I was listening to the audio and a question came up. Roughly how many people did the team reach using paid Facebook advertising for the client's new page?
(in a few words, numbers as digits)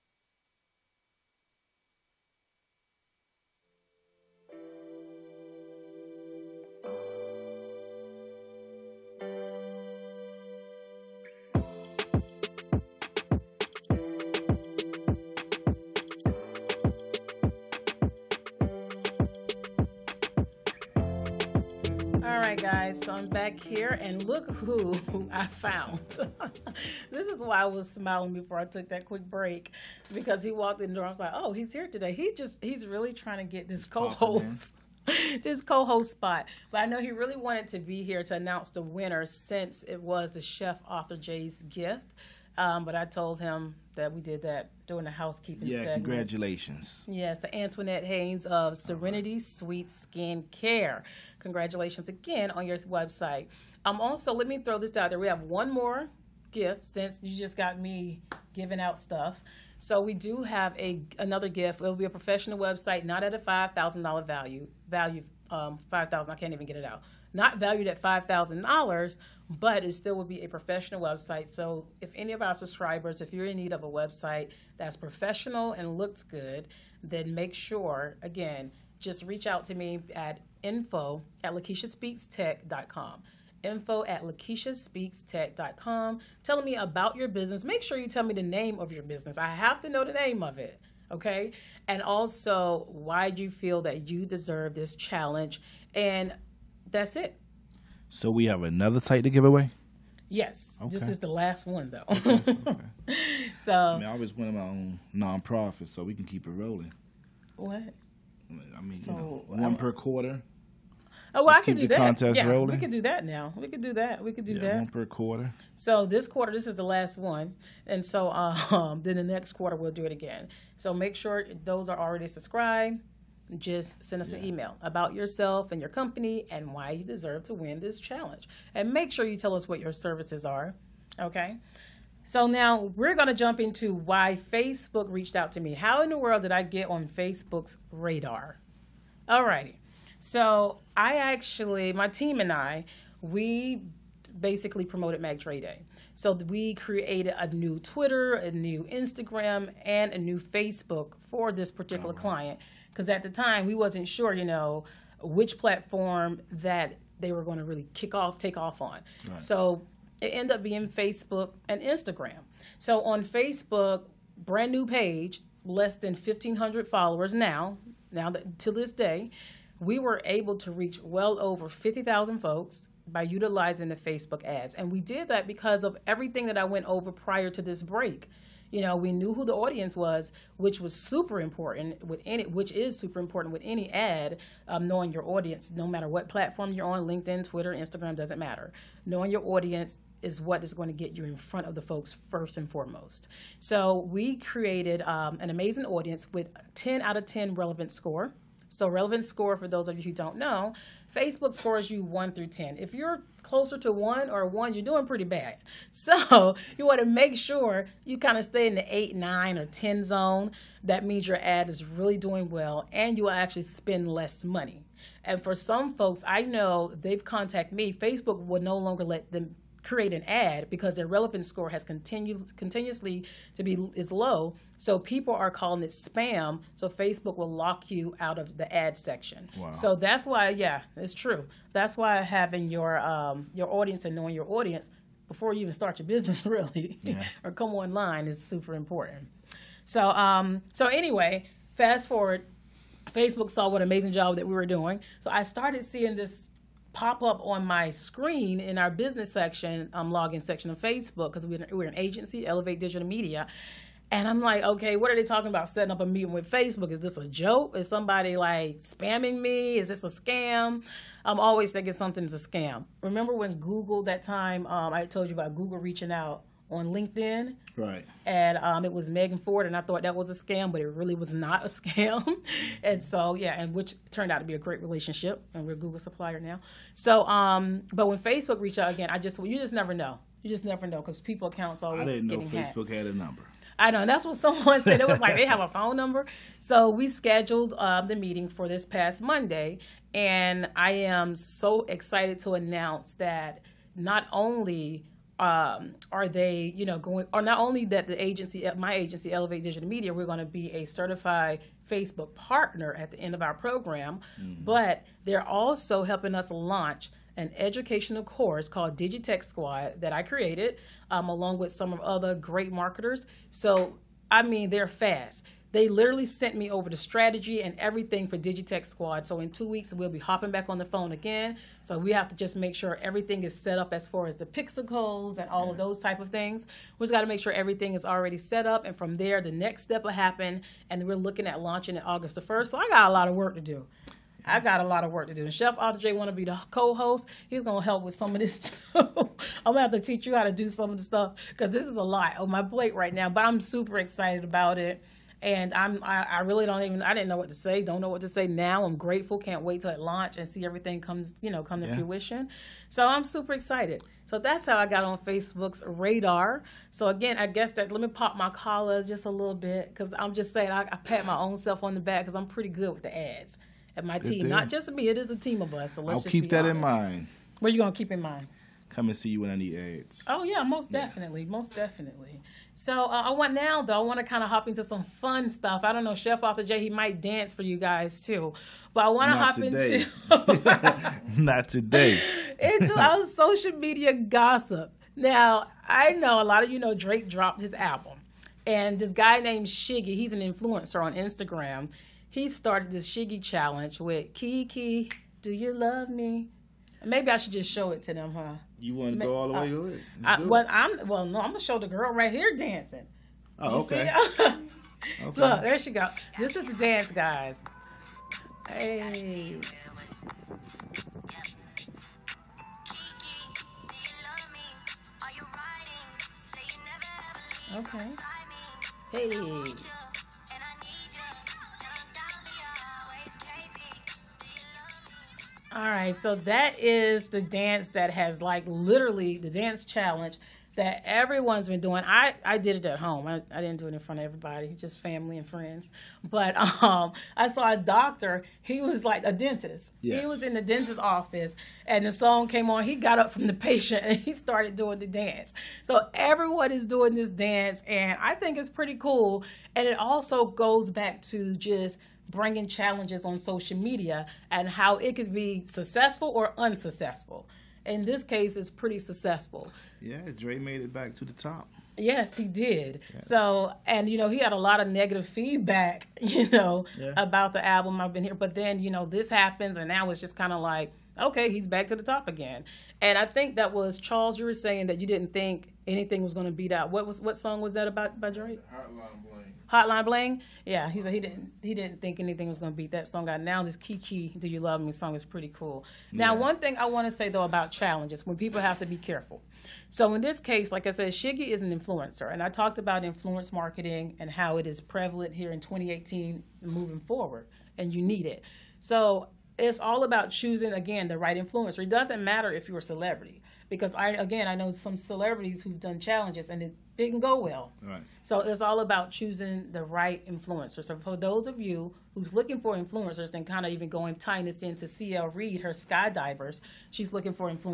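over 50,000.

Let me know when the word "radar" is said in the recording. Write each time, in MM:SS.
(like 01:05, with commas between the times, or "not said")
02:17, 05:55.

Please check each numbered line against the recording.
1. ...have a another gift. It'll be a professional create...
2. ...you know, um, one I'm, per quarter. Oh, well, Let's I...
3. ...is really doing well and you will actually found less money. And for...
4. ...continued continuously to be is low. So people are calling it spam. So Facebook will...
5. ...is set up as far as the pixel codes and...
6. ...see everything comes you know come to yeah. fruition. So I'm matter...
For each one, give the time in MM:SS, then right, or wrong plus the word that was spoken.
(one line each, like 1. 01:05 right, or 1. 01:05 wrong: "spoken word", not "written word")
1. 01:00 wrong: "website", not "create"
2. 01:49 right
3. 03:31 wrong: "spend", not "found"
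4. 03:41 right
5. 05:23 right
6. 05:50 wrong: "super", not "matter".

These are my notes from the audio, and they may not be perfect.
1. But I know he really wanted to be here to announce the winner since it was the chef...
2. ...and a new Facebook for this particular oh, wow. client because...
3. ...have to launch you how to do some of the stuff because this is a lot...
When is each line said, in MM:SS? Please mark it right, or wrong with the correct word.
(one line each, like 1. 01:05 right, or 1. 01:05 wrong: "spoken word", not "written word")
1. 00:36 right
2. 02:29 right
3. 05:39 wrong: "teach", not "launch".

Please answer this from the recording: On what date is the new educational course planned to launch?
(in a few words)
August 1.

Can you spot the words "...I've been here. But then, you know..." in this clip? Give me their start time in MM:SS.
07:47.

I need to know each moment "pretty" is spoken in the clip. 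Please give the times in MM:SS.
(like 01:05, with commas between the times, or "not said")
03:25, 06:02, 07:28, 07:38, 08:05.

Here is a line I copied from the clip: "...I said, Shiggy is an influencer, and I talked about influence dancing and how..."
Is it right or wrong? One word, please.
wrong.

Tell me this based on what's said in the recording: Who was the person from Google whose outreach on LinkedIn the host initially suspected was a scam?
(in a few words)
Megan Ford.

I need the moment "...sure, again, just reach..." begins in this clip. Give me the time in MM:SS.
01:17.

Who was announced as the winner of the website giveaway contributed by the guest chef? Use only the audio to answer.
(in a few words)
Antoinette Haynes.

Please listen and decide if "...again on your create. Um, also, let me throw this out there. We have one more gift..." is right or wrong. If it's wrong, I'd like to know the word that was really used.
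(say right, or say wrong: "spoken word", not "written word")
wrong: "website", not "create".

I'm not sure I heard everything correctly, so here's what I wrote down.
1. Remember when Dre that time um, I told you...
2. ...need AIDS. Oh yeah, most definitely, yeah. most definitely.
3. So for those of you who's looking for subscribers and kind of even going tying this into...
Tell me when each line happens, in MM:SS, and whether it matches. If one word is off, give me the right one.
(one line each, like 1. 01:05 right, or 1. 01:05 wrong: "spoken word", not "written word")
1. 04:23 wrong: "Google", not "Dre"
2. 06:09 right
3. 08:30 wrong: "influencers", not "subscribers".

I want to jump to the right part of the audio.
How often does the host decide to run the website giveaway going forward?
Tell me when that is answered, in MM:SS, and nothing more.
01:54.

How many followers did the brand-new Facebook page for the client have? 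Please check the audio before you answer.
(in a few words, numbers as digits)
less than 1,500.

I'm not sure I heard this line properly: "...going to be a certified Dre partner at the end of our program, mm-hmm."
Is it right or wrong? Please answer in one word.
wrong.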